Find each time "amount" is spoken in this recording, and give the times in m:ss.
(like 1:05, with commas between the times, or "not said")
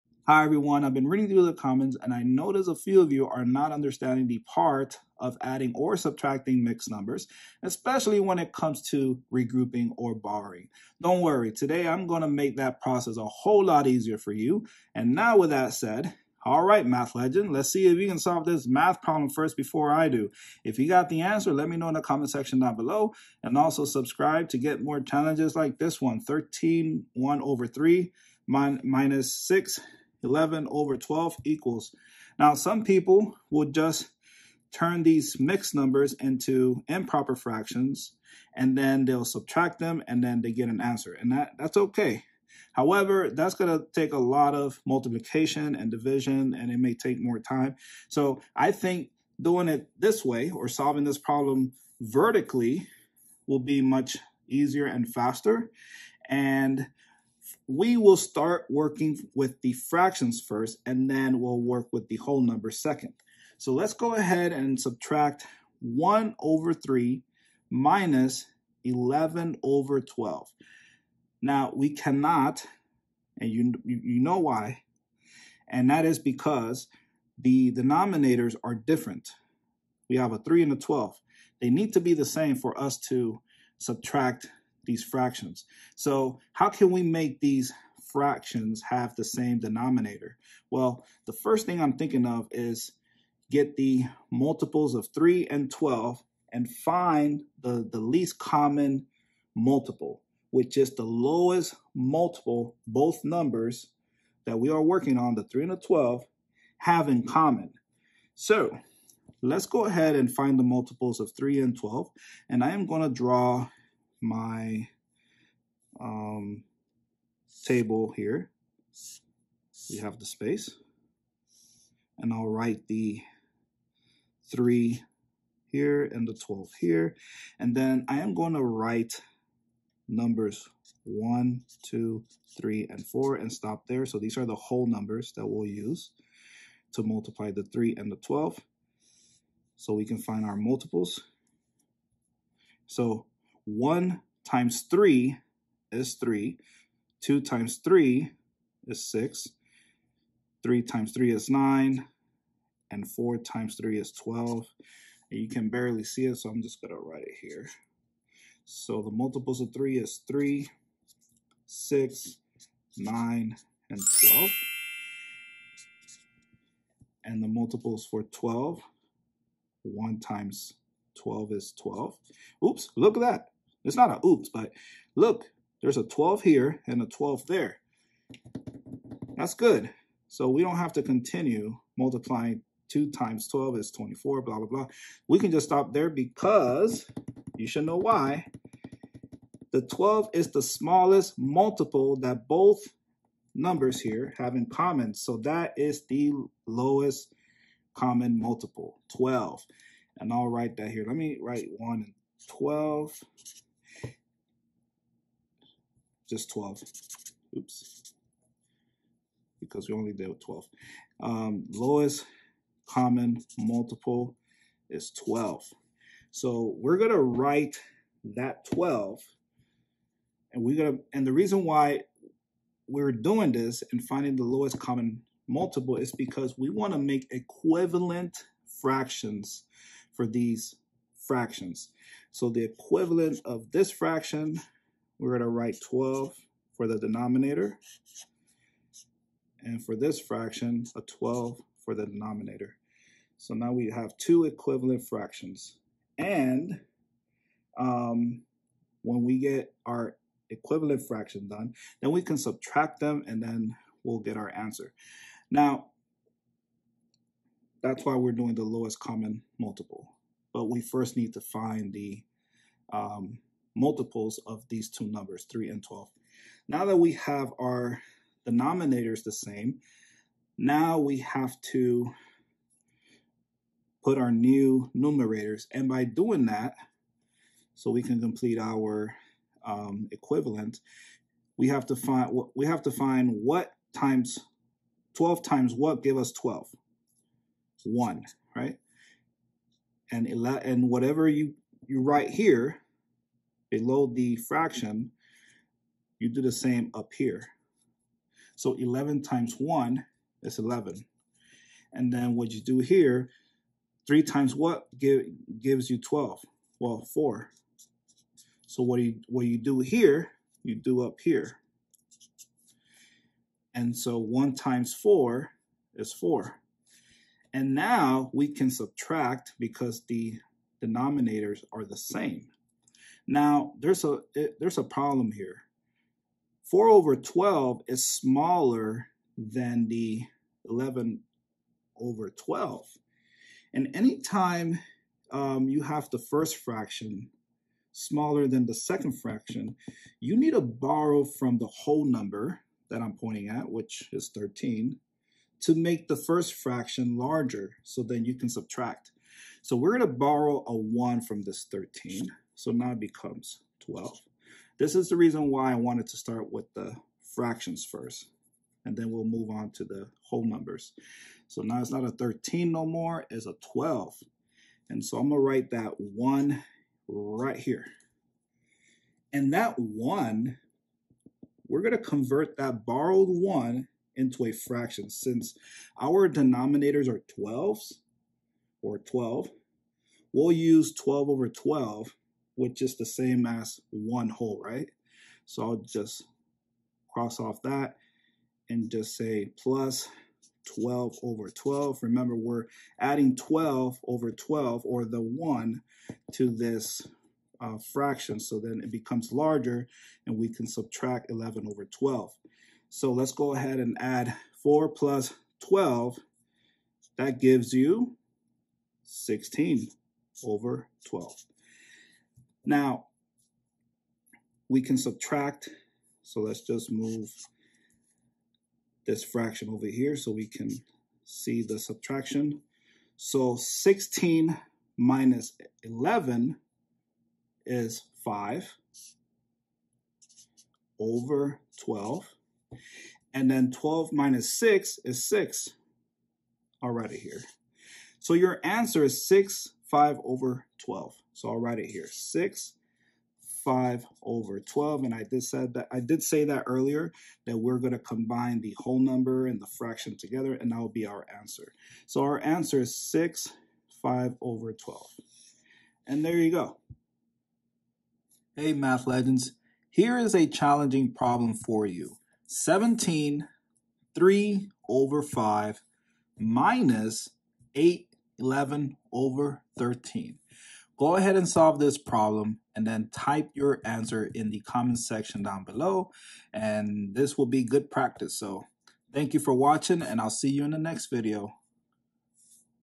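not said.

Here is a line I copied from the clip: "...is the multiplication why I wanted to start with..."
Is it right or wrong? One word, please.
wrong.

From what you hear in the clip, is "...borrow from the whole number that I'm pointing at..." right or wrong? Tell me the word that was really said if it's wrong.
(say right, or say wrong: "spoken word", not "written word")
right.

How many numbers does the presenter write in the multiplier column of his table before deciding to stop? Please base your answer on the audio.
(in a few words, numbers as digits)
4.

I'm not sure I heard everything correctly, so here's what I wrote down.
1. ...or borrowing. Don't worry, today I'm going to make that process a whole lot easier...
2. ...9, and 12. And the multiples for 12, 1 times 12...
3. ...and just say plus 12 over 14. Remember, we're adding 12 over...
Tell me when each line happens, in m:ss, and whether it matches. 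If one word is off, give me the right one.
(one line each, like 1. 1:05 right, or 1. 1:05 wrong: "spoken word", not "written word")
1. 0:09 right
2. 2:42 right
3. 6:28 wrong: "12", not "14".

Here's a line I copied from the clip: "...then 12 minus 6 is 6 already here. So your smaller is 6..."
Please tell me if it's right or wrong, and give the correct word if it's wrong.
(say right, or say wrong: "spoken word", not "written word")
wrong: "answer", not "smaller".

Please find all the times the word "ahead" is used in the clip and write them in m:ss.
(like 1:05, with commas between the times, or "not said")
1:04, 1:49, 6:43, 7:51.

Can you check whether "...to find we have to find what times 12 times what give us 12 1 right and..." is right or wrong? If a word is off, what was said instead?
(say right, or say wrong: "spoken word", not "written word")
right.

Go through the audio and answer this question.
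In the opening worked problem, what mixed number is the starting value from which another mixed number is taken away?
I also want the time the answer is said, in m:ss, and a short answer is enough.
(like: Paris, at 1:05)
13 1/3, at 0:26.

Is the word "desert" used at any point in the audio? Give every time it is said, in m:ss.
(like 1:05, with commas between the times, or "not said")
not said.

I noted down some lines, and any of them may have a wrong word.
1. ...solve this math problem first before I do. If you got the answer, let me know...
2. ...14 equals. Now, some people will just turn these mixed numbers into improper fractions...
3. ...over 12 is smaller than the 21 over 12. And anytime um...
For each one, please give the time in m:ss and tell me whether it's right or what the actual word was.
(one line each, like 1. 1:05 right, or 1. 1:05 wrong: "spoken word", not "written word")
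1. 0:18 right
2. 0:30 wrong: "12", not "14"
3. 5:26 wrong: "11", not "21".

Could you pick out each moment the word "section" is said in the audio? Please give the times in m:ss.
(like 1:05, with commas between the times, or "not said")
0:22, 7:54.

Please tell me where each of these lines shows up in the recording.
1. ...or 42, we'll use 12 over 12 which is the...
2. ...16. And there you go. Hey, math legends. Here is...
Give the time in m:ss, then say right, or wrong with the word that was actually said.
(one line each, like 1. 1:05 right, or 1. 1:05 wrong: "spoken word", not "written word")
1. 6:18 wrong: "12", not "42"
2. 7:34 wrong: "12", not "16".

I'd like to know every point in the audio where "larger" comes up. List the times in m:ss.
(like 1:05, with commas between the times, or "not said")
5:47, 6:39.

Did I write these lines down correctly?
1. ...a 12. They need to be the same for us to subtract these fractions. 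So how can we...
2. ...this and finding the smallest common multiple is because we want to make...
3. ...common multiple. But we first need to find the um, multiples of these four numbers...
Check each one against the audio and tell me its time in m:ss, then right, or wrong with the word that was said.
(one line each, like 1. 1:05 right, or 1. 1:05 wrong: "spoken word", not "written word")
1. 1:20 right
2. 3:43 wrong: "lowest", not "smallest"
3. 4:18 wrong: "two", not "four".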